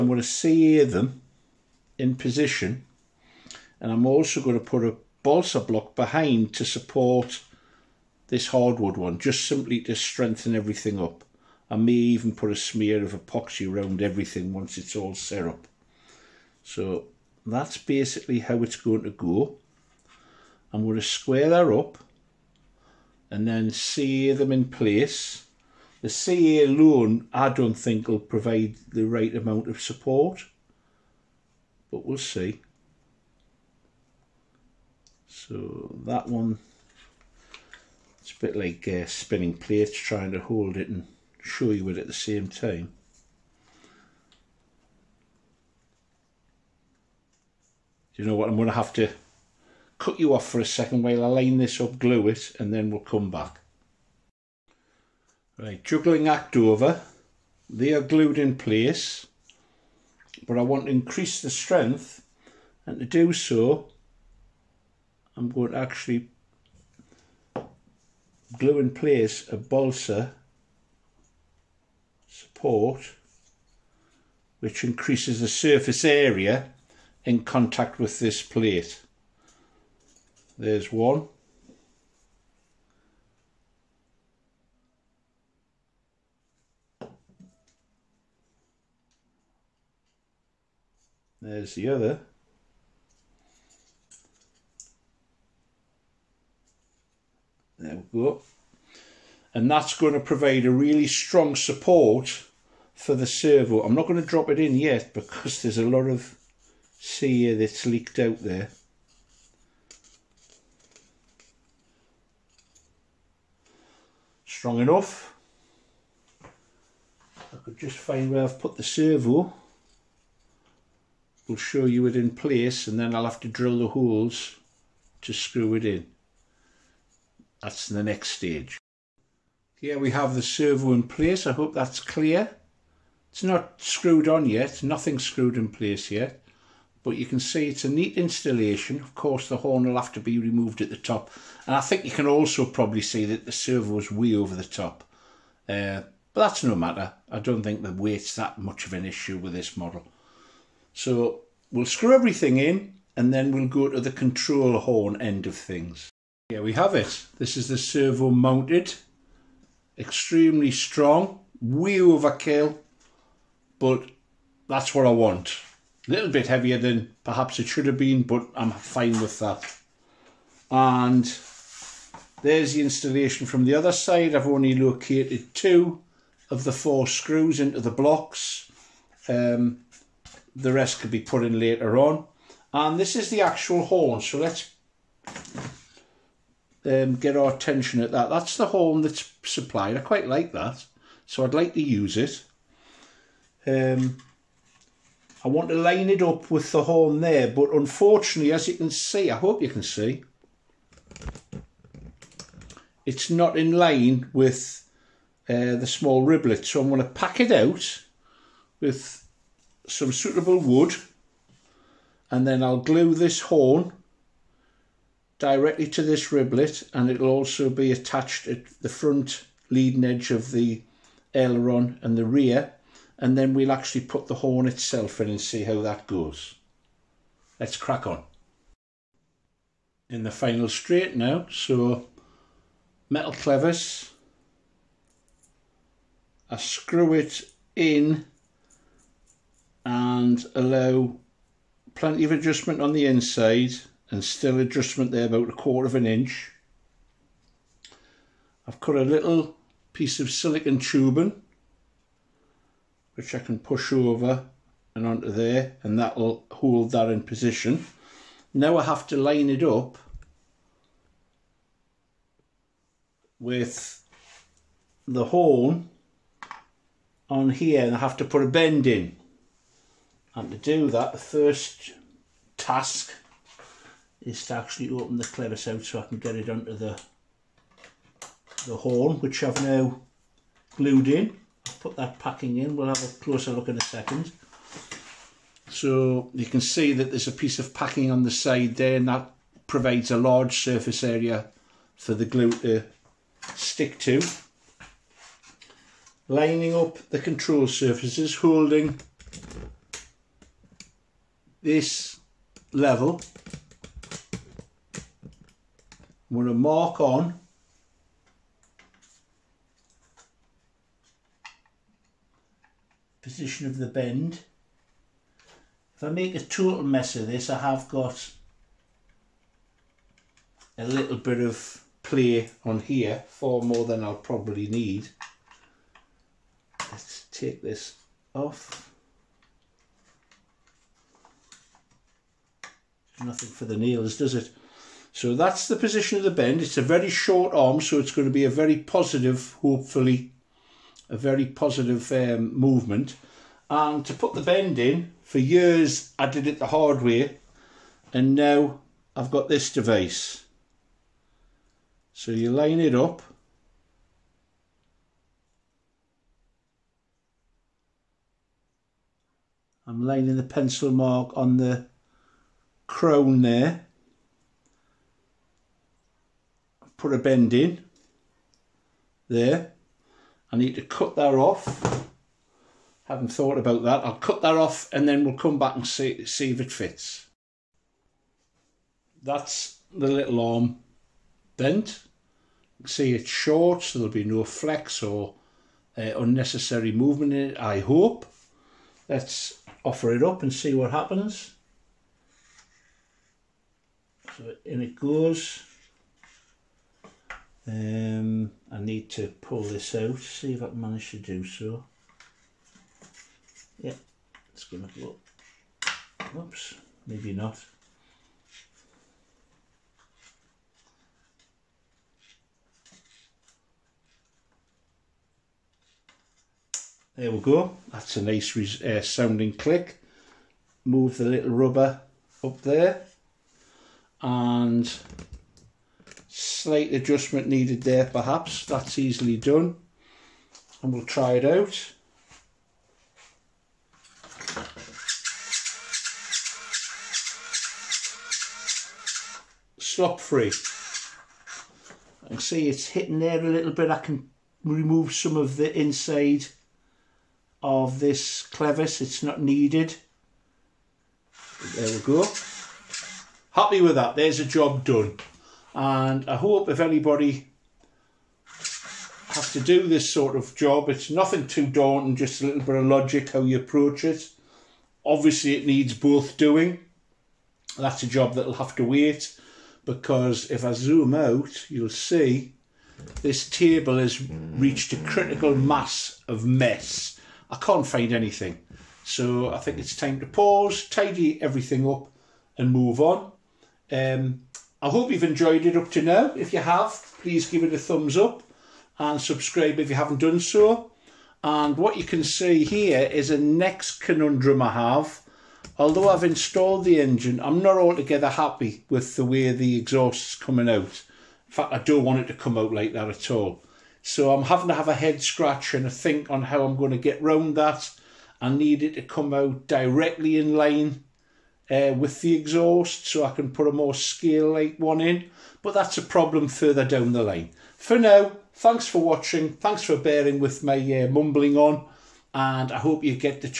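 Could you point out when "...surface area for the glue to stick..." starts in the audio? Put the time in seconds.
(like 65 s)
290 s.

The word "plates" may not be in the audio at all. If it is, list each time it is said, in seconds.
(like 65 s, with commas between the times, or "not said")
39 s, 78 s.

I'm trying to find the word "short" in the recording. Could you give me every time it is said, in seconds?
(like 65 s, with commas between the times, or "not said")
337 s, 383 s.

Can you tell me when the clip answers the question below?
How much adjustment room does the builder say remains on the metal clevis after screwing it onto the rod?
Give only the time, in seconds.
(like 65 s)
245 s.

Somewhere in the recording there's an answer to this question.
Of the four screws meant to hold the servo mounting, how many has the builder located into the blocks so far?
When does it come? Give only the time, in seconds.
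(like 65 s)
175 s.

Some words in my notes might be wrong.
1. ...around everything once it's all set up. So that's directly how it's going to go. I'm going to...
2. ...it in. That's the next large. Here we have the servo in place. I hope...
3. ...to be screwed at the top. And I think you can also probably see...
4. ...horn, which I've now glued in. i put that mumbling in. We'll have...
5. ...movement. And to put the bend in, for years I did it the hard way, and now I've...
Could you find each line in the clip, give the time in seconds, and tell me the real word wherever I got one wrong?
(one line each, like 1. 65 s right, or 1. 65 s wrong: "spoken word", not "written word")
1. 13 s wrong: "basically", not "directly"
2. 125 s wrong: "stage", not "large"
3. 140 s wrong: "removed", not "screwed"
4. 278 s wrong: "packing", not "mumbling"
5. 342 s right.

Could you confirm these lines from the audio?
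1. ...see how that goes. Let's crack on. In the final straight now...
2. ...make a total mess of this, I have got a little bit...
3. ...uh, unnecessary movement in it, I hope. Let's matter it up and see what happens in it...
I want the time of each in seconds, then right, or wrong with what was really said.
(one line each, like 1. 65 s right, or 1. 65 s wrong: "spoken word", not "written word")
1. 225 s right
2. 316 s right
3. 385 s wrong: "offer", not "matter".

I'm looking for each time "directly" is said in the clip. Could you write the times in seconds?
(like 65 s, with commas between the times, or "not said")
215 s, 509 s.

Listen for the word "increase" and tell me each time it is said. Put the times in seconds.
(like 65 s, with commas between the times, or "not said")
60 s, 74 s.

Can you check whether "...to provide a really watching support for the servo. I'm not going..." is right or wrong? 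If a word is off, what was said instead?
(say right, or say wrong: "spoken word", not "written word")
wrong: "strong", not "watching".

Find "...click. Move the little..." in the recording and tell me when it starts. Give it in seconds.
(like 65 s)
419 s.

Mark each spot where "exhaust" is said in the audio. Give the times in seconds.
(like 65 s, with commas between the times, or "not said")
499 s, 512 s.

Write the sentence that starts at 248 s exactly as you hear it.
I've cut a little piece of silicon tubing which I can push over and onto there and that'll hold that in position.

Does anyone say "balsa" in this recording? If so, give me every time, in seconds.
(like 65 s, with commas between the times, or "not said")
5 s, 69 s.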